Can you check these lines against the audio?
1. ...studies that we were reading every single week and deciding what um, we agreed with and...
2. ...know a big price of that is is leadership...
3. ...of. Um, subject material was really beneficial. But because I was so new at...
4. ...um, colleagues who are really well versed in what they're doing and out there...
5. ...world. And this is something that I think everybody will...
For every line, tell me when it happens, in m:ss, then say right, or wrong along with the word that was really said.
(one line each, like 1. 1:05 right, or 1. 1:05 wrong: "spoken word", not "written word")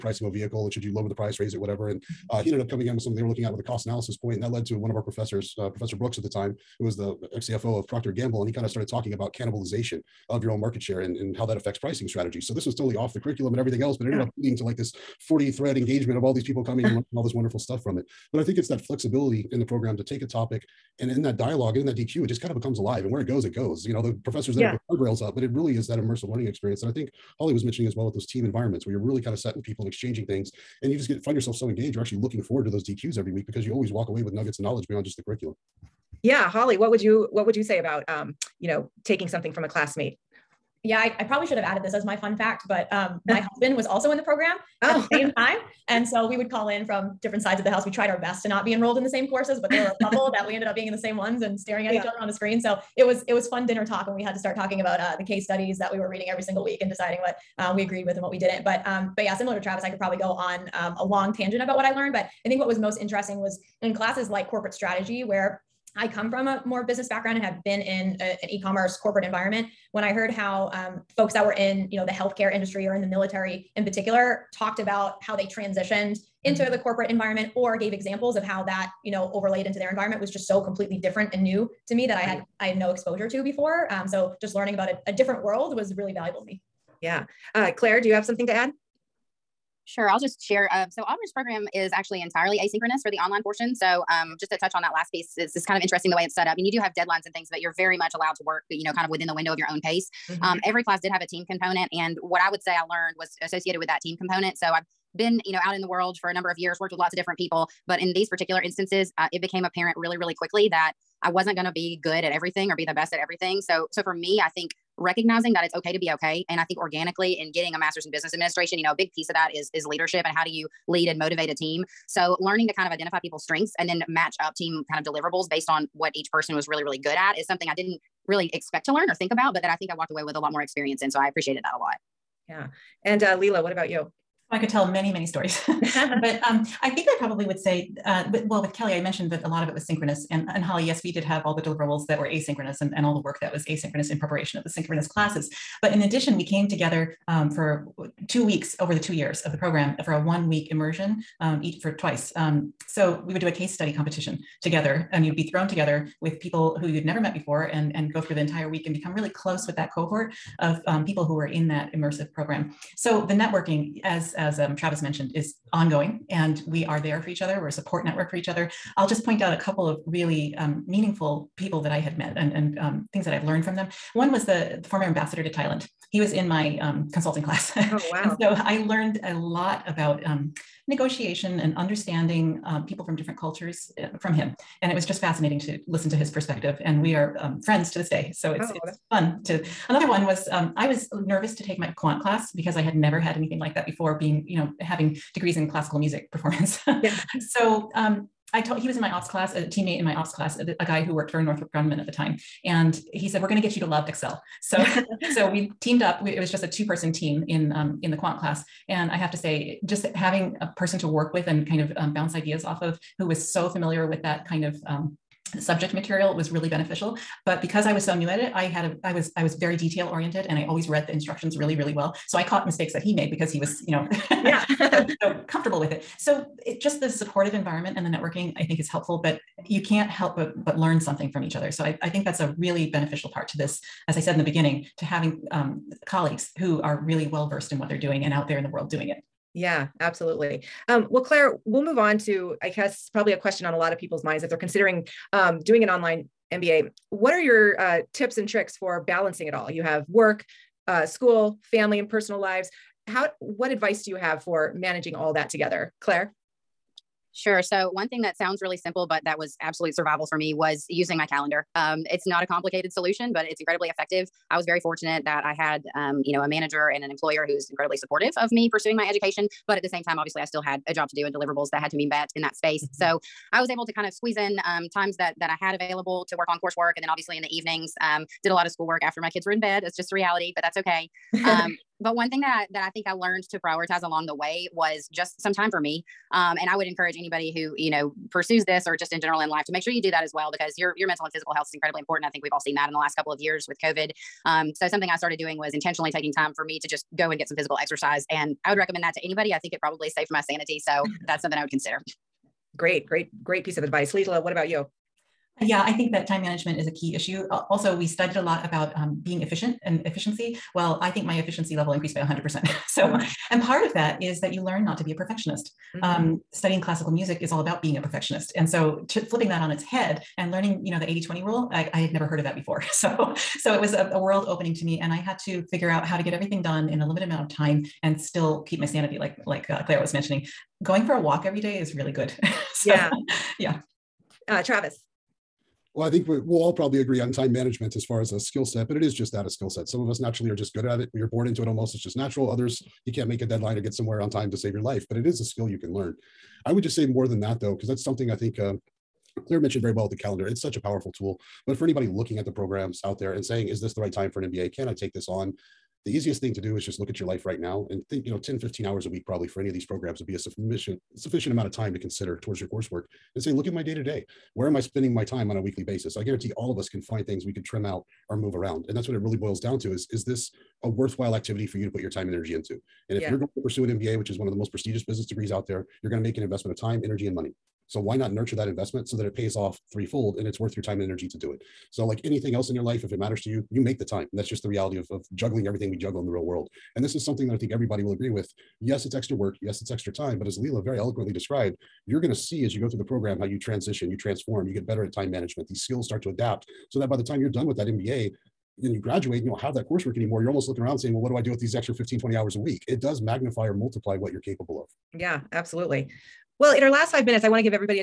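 1. 0:55 right
2. 1:58 wrong: "piece", not "price"
3. 3:34 right
4. 3:55 right
5. 6:26 right.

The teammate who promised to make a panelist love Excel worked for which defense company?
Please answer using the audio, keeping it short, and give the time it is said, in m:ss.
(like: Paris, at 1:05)
Northrop Grumman, at 3:21.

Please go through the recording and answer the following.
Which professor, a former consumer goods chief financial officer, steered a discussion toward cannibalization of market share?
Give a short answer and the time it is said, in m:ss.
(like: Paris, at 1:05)
Professor Brooks, at 0:05.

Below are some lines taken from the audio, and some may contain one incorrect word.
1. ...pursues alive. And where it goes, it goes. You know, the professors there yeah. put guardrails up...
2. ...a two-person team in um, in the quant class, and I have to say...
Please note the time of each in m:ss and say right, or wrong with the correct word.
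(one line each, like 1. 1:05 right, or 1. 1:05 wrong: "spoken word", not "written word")
1. 0:22 wrong: "becomes", not "pursues"
2. 3:26 right.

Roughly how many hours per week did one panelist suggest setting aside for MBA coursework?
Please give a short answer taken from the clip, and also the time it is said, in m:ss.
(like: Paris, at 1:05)
10 to 15, at 5:58.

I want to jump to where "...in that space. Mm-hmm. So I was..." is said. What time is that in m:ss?
4:32.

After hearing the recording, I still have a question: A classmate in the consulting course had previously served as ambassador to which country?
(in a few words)
Thailand.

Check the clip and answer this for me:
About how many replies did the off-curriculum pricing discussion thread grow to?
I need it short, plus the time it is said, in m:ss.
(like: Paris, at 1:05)
40, at 0:15.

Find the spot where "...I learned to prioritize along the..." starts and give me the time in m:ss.
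4:43.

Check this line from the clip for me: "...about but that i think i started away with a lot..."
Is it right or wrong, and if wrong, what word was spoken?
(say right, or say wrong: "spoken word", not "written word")
wrong: "walked", not "started".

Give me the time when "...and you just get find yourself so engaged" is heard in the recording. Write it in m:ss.
0:30.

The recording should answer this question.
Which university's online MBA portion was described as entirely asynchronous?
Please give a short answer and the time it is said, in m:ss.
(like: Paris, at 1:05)
Auburn, at 1:31.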